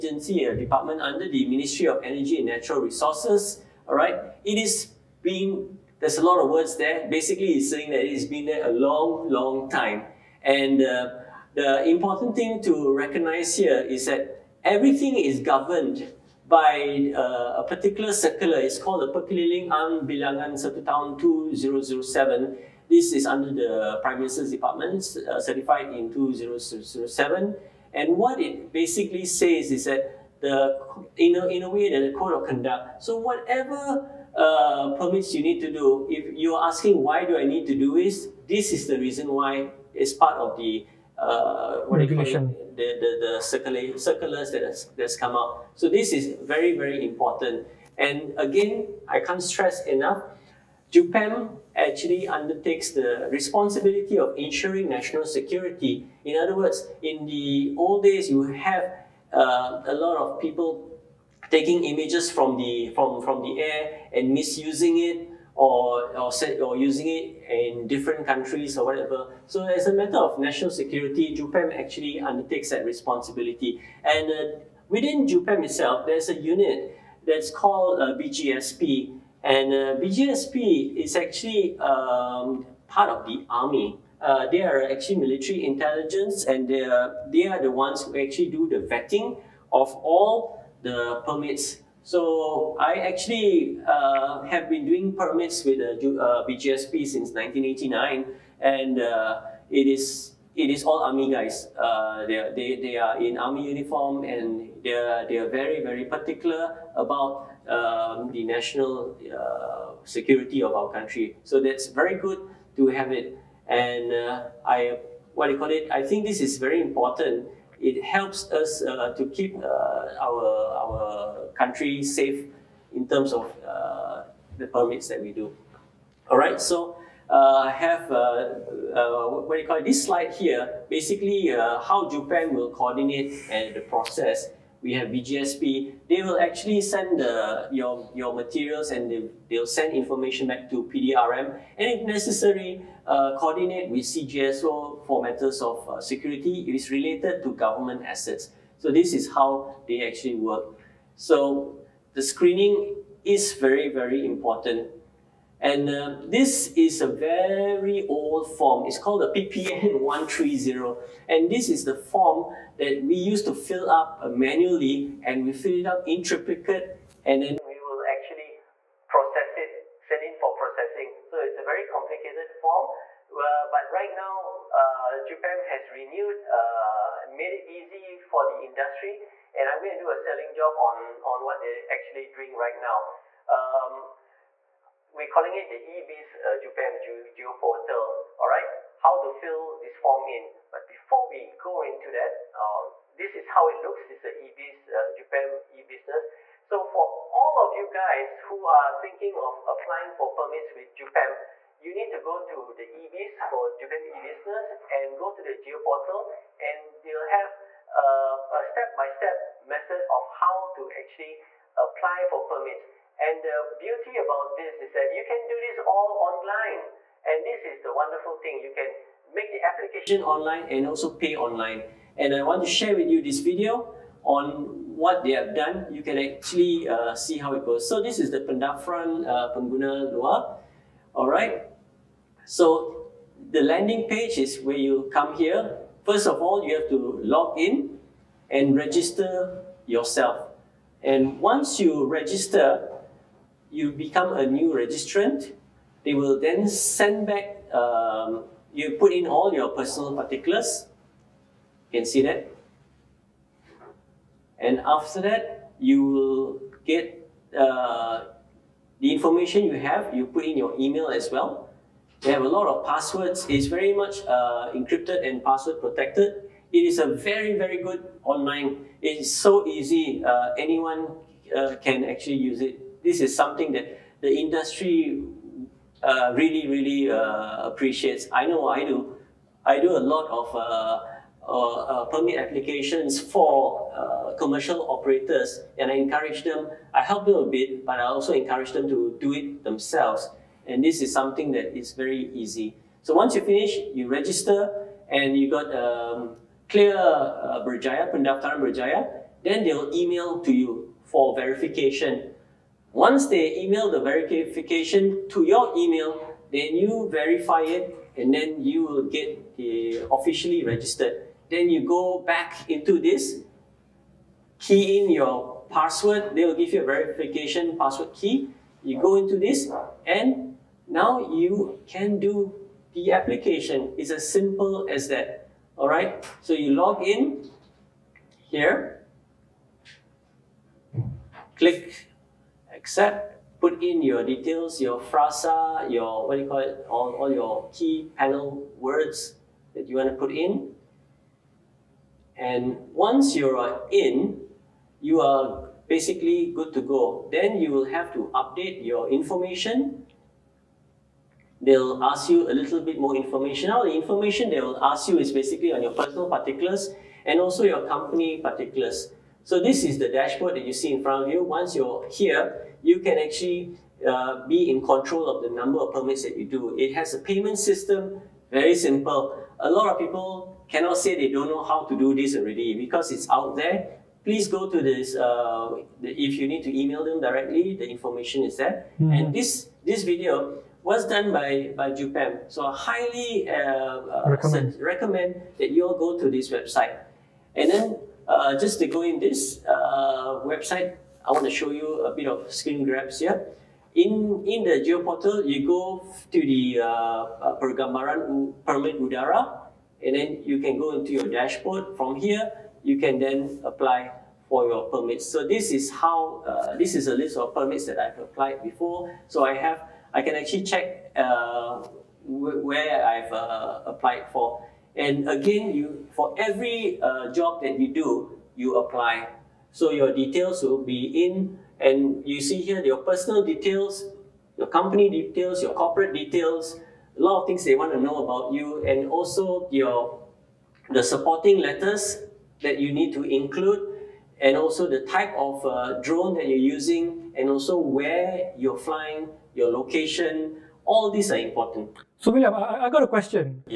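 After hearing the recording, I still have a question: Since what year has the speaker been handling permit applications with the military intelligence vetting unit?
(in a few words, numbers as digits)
1989.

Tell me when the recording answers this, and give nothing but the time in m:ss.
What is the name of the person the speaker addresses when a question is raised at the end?
7:22.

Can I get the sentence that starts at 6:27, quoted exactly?
And then uh, just to go in this uh, website, I want to show you a bit of screen grabs here.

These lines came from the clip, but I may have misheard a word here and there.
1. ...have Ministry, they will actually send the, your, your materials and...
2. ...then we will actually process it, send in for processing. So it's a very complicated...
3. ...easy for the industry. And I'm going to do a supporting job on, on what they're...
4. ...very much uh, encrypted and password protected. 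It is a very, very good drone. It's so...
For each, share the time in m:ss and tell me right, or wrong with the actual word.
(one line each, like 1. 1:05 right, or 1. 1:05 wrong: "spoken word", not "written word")
1. 2:14 wrong: "BGSP", not "Ministry"
2. 2:47 right
3. 2:57 wrong: "selling", not "supporting"
4. 4:23 wrong: "online", not "drone".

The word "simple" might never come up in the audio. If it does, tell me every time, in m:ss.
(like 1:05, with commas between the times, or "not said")
5:24, 6:08.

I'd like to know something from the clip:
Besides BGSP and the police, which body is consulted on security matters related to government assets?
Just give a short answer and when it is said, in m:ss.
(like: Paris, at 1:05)
CGSO, at 2:24.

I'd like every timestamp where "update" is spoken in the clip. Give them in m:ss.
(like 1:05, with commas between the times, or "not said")
5:48.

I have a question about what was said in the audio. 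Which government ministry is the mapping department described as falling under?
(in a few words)
Ministry of Energy and Natural Resources.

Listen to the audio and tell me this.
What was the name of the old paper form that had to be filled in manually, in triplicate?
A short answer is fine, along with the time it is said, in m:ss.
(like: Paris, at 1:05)
PPN 130, at 2:39.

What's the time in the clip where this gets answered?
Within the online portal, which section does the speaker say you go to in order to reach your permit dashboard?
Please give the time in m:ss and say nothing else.
6:37.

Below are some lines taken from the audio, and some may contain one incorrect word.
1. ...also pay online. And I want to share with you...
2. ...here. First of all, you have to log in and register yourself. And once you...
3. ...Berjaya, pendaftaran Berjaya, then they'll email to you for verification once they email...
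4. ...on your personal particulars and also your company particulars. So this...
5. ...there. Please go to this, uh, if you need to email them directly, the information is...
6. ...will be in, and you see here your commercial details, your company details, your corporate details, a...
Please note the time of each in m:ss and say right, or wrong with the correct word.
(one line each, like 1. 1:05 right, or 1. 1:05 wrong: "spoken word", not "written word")
1. 3:40 right
2. 3:55 right
3. 4:57 right
4. 5:55 right
5. 6:13 right
6. 7:00 wrong: "personal", not "commercial".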